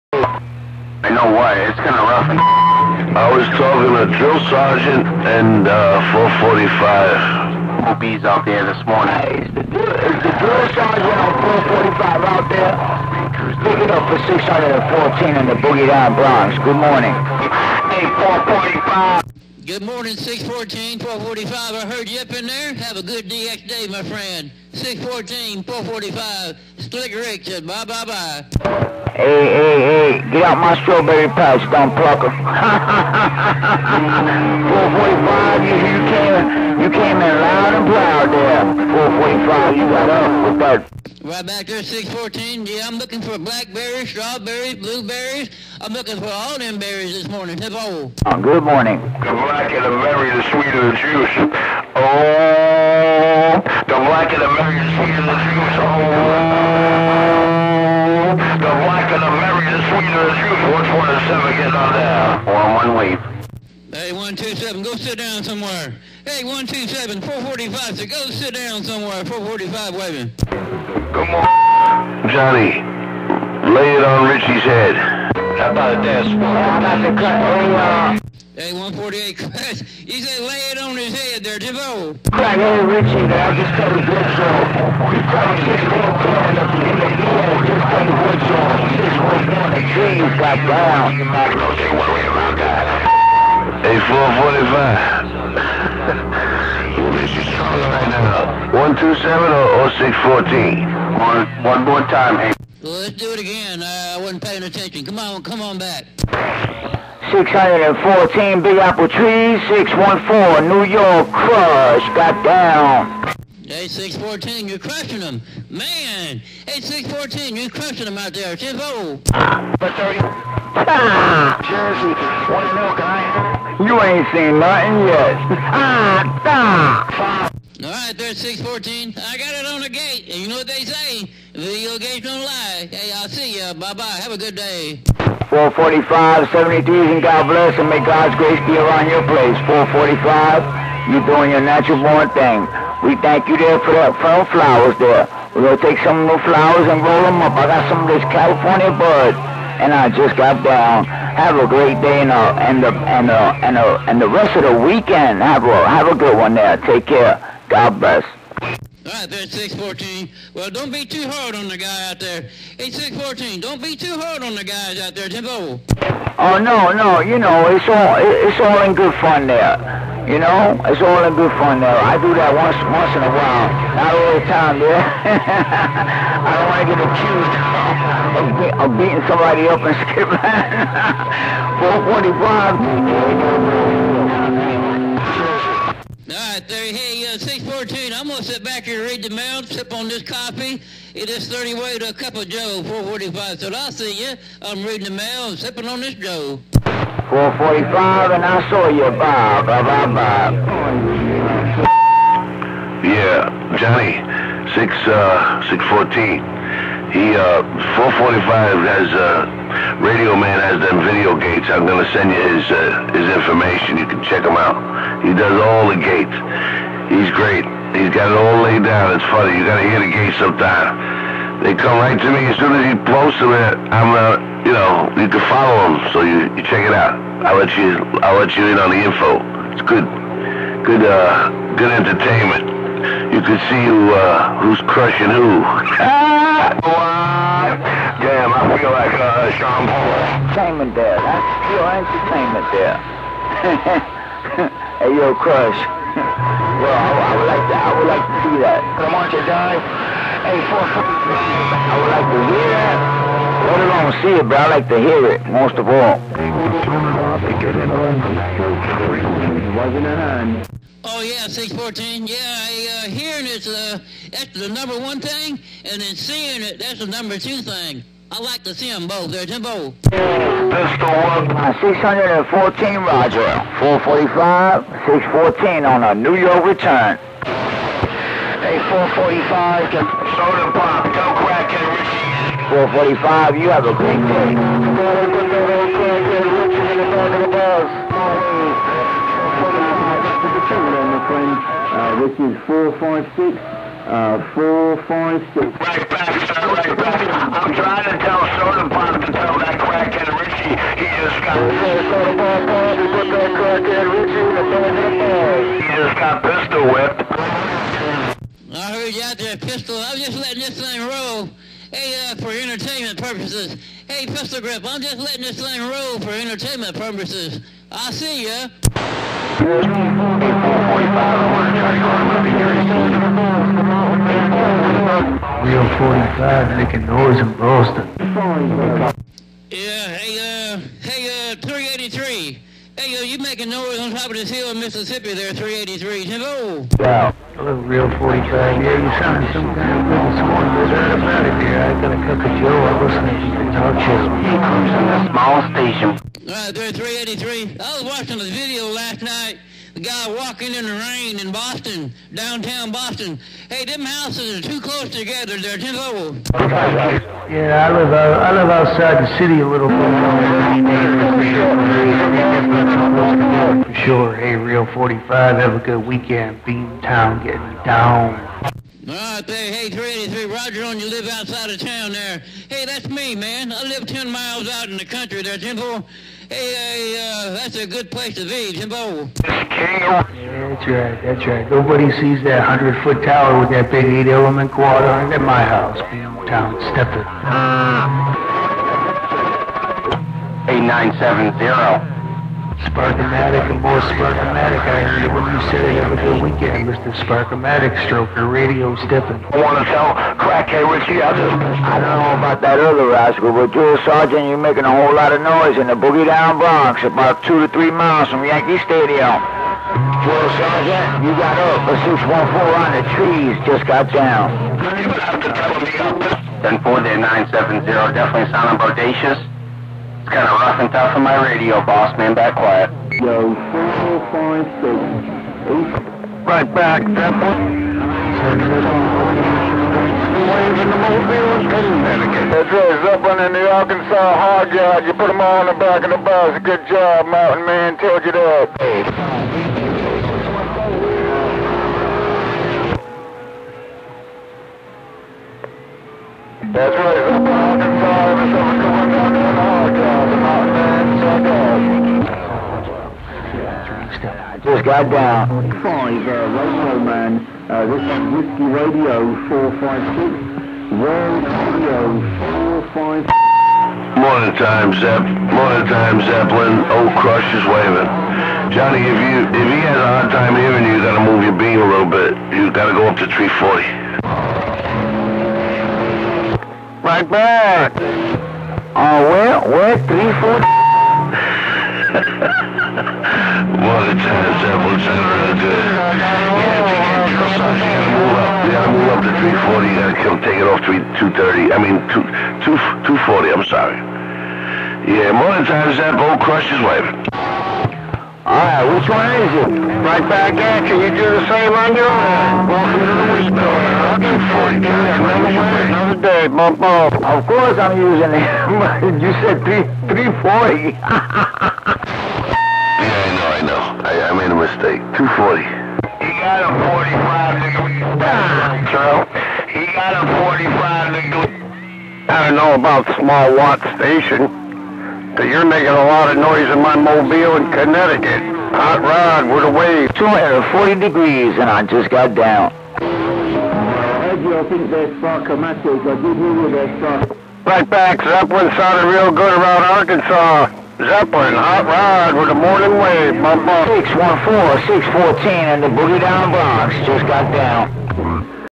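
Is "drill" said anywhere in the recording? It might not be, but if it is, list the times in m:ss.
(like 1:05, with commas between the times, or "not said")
0:04, 0:10.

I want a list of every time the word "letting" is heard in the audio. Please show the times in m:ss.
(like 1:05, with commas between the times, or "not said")
5:10, 5:15.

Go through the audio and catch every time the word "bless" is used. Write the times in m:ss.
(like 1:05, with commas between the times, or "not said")
2:17, 2:37.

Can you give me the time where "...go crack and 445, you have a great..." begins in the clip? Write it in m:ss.
4:41.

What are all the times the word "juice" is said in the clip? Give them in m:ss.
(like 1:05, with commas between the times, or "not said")
0:50, 0:55, 1:00.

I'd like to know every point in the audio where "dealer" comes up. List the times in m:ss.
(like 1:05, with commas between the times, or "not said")
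not said.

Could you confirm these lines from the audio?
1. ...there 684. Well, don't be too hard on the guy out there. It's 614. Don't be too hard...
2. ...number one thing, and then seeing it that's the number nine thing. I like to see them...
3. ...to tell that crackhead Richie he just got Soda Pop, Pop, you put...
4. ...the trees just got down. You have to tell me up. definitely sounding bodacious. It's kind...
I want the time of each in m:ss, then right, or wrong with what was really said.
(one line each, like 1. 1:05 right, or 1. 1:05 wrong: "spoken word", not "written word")
1. 2:39 wrong: "614", not "684"
2. 4:24 wrong: "two", not "nine"
3. 4:59 right
4. 6:52 right.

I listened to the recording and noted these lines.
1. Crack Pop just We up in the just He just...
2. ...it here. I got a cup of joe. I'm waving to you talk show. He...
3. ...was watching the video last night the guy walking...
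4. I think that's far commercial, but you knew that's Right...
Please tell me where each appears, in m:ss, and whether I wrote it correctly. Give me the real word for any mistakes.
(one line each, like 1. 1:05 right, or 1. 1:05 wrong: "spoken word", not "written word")
1. 1:22 wrong: "Richie", not "Pop"
2. 5:41 wrong: "listening", not "waving"
3. 5:47 right
4. 8:54 right.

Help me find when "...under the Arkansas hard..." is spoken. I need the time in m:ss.
7:13.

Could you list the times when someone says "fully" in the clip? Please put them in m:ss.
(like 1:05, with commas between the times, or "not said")
not said.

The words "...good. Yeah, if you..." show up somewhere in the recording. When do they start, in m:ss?
8:05.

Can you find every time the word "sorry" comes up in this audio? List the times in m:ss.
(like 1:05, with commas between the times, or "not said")
8:13.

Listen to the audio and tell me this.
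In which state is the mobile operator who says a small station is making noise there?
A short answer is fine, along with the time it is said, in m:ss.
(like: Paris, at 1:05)
Connecticut, at 8:47.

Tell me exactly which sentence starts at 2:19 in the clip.
445, you're doing your natural born thing.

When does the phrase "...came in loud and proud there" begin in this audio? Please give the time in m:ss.
0:36.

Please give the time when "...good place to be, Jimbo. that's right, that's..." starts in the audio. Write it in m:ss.
6:17.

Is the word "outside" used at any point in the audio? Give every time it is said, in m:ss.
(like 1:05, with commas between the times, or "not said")
5:58, 6:11.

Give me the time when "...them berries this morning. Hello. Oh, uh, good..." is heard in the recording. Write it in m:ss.
0:46.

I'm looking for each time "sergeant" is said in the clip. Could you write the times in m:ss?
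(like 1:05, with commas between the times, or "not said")
0:04, 0:10, 6:44, 6:50.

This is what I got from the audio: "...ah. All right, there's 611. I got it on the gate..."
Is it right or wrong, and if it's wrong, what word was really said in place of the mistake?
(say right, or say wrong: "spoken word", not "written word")
wrong: "614", not "611".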